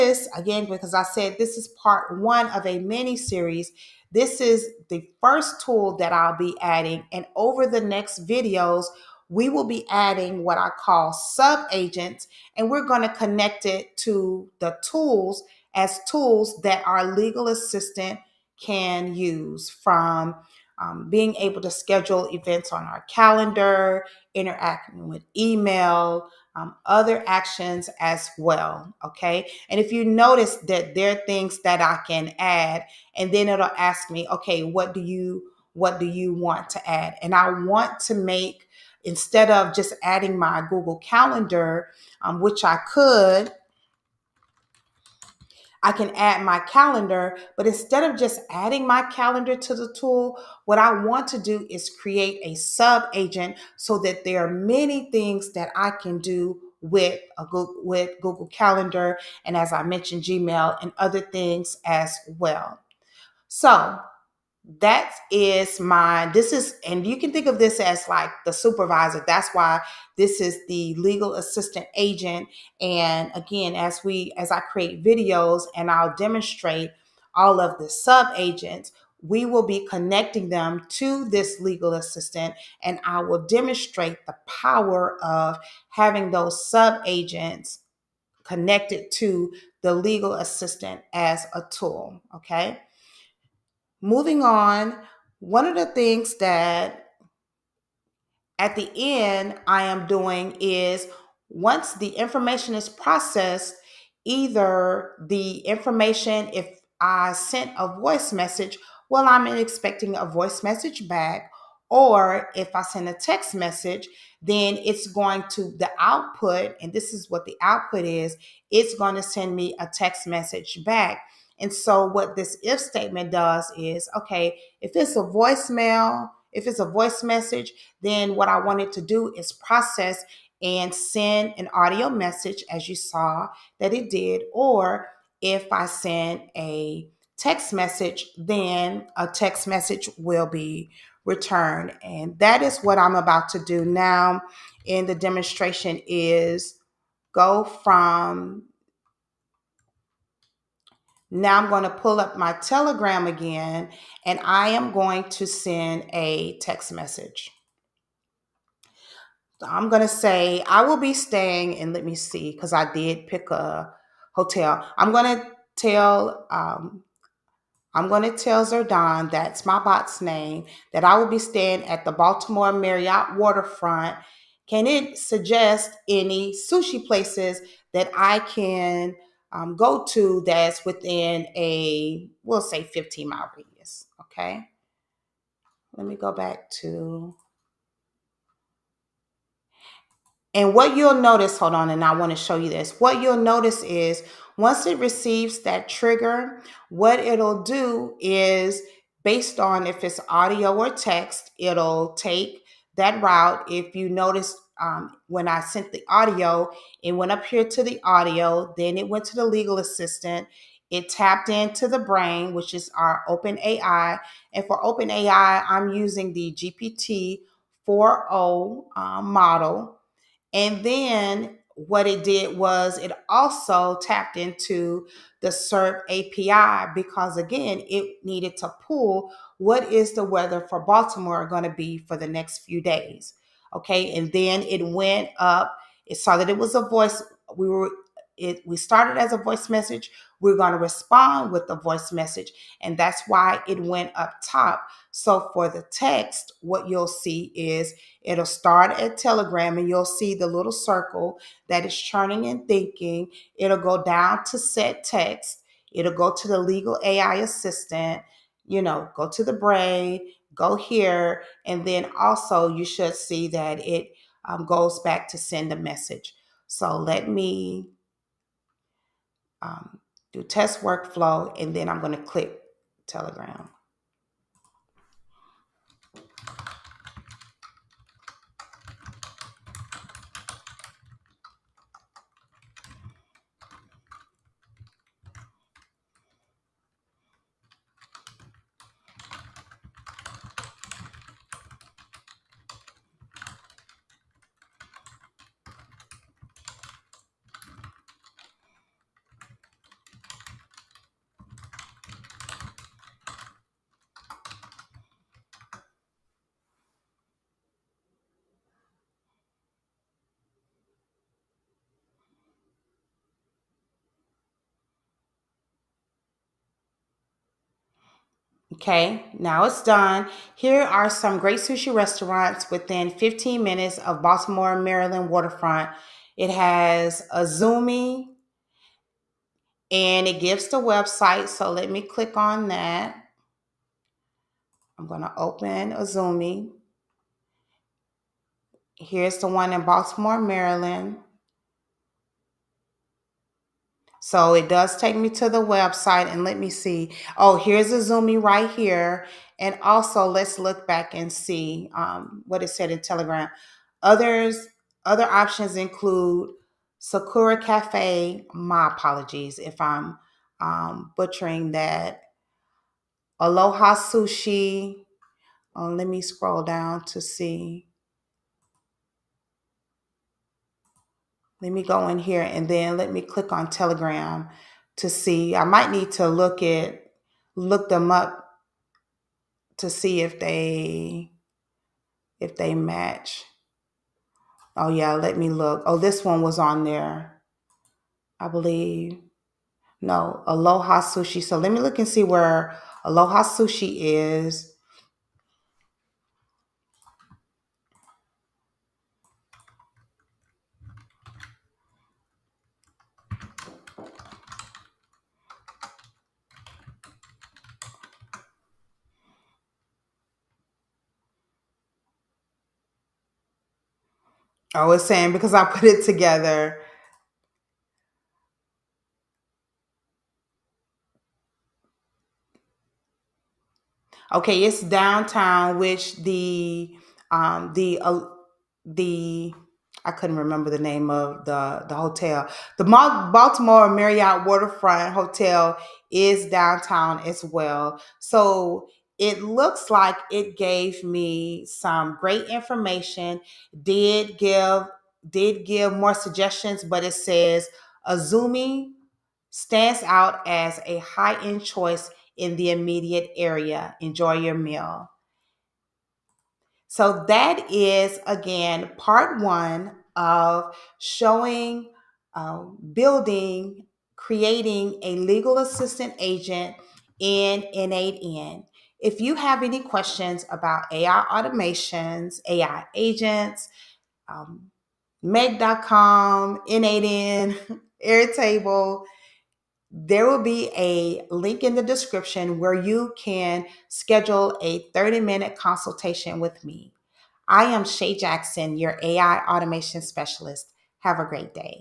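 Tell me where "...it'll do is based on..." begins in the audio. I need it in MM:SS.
03:17.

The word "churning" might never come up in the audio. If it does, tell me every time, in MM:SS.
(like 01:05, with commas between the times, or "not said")
04:11.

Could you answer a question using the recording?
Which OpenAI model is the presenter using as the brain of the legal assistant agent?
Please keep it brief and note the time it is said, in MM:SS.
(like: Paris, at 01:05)
GPT 4.0, at 03:36.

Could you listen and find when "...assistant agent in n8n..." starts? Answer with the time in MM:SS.
07:45.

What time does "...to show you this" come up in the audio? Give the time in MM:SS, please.
03:12.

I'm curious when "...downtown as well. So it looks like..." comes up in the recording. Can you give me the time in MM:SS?
07:16.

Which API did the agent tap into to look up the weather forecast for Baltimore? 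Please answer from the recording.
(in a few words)
SERP API.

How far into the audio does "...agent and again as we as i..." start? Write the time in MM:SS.
01:11.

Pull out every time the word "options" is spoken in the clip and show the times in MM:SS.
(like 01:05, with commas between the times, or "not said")
05:55.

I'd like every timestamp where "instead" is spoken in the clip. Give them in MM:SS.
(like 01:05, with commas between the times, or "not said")
00:39, 00:47.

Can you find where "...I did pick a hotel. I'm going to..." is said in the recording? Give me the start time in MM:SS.
02:42.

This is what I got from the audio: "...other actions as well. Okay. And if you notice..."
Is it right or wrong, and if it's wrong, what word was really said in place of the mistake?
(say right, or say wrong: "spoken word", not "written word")
right.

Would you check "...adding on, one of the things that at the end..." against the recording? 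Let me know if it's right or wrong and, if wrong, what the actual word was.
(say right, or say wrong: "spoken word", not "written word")
wrong: "moving", not "adding".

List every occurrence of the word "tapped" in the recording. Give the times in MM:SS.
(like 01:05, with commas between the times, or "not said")
03:31, 03:44.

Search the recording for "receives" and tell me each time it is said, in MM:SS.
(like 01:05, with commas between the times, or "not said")
03:14.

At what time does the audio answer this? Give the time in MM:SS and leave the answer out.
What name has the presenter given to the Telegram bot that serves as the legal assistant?
02:48.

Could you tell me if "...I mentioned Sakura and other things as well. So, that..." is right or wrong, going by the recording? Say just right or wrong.
wrong.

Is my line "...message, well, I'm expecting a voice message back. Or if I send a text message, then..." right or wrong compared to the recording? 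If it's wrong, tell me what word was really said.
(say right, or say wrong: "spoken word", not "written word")
right.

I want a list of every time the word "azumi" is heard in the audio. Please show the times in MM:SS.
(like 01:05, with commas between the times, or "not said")
05:27, 05:35, 05:47, 07:28.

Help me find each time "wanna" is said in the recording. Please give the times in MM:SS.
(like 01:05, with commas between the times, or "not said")
not said.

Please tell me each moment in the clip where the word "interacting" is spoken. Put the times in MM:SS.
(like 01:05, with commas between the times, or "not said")
00:24.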